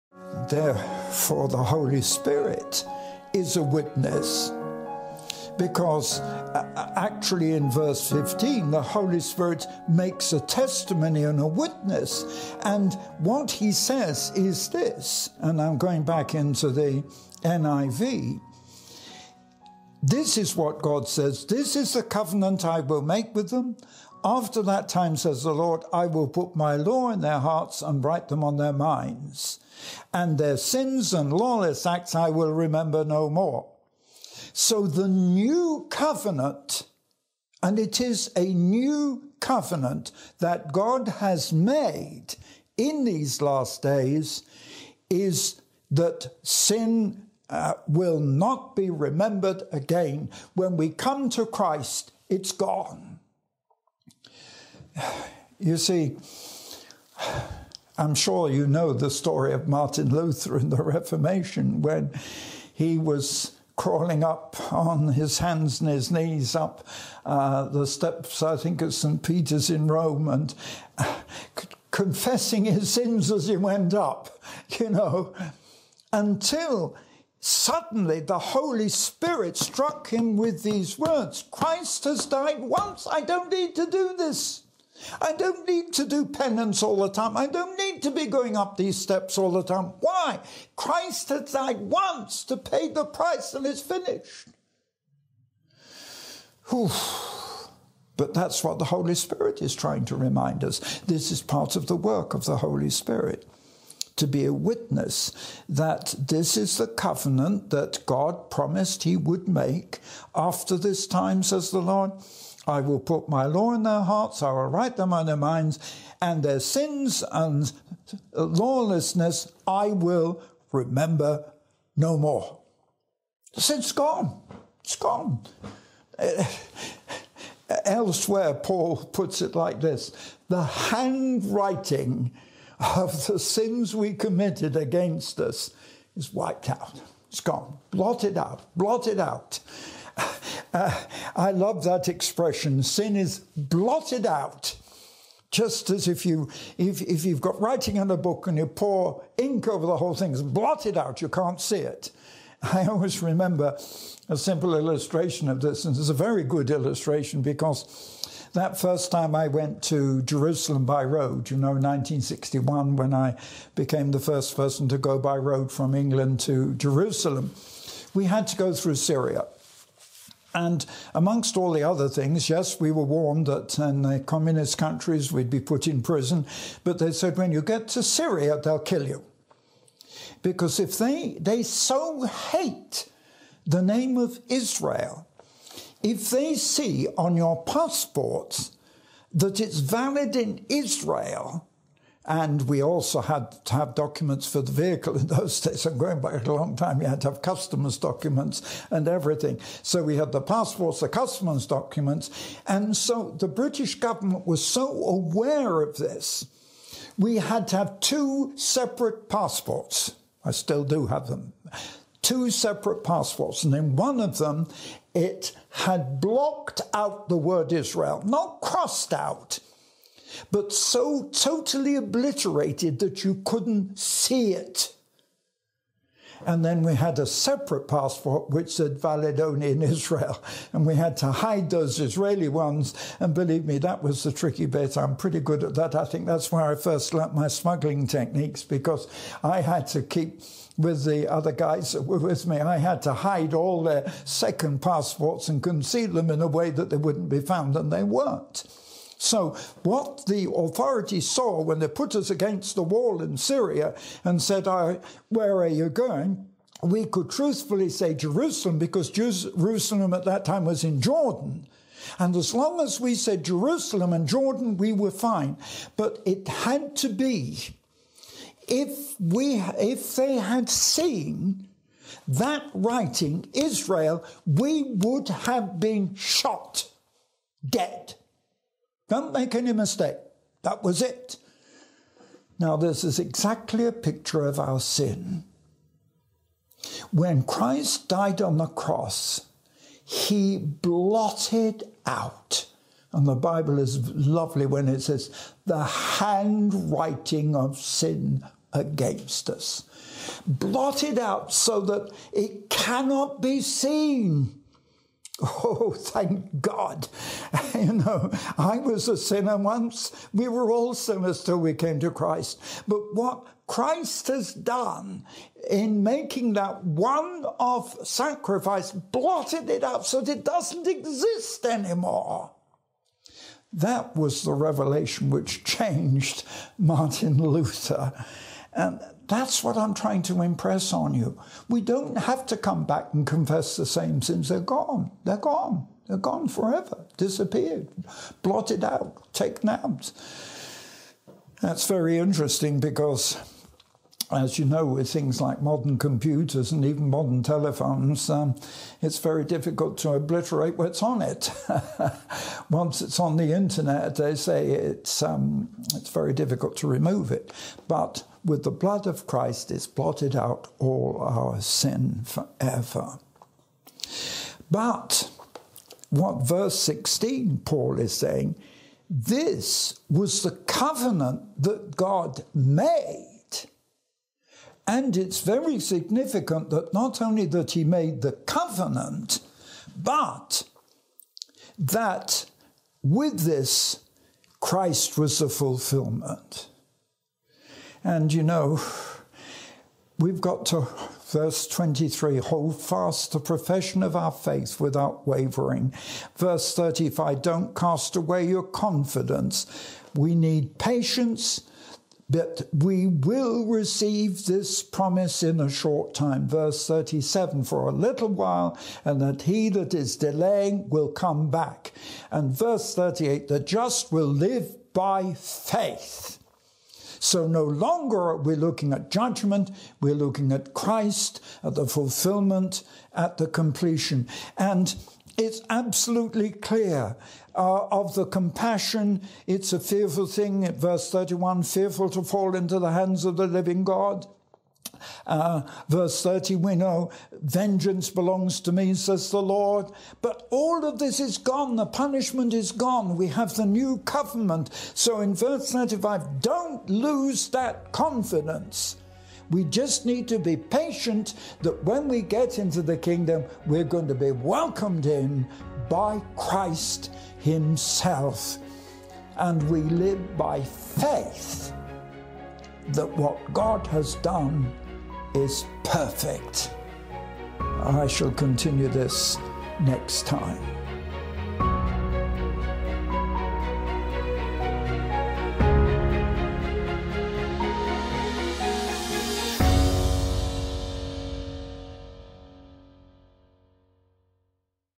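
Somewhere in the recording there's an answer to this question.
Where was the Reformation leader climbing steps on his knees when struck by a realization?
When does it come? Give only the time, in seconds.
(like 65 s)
68 s.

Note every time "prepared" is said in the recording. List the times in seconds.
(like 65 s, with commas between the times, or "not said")
not said.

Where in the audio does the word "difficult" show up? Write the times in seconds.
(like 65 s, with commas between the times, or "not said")
349 s, 356 s.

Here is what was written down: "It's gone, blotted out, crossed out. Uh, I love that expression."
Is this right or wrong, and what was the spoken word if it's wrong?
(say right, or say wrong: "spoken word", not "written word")
wrong: "blotted", not "crossed".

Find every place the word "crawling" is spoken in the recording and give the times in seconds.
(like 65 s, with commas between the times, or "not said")
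63 s.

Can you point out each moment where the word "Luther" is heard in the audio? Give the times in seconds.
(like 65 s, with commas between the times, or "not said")
60 s, 327 s.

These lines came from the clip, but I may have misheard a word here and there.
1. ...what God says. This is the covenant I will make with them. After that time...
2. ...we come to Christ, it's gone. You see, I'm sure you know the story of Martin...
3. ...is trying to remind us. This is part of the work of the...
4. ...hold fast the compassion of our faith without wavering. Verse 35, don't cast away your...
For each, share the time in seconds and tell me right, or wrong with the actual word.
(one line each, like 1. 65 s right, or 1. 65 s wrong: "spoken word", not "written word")
1. 20 s right
2. 50 s right
3. 99 s right
4. 392 s wrong: "profession", not "compassion".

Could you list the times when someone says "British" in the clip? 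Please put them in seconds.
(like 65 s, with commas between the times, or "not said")
203 s.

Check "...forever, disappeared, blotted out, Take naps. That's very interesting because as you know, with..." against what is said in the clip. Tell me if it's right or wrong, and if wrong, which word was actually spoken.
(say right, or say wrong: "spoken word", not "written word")
right.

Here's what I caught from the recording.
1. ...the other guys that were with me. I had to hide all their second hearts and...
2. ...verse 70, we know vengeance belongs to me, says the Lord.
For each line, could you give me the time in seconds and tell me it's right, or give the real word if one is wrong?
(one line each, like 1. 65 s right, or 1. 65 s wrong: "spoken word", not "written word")
1. 241 s wrong: "passports", not "hearts"
2. 435 s wrong: "30", not "70".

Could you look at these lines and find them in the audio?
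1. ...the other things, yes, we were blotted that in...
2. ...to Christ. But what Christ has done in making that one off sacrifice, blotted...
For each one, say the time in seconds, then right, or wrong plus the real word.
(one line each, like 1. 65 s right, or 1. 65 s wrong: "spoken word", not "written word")
1. 171 s wrong: "warned", not "blotted"
2. 312 s right.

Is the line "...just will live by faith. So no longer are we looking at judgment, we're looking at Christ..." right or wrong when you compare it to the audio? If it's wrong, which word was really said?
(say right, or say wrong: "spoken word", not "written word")
right.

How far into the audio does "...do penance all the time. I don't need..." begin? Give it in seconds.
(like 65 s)
86 s.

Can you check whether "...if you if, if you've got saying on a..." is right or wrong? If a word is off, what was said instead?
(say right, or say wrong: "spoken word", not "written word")
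wrong: "writing", not "saying".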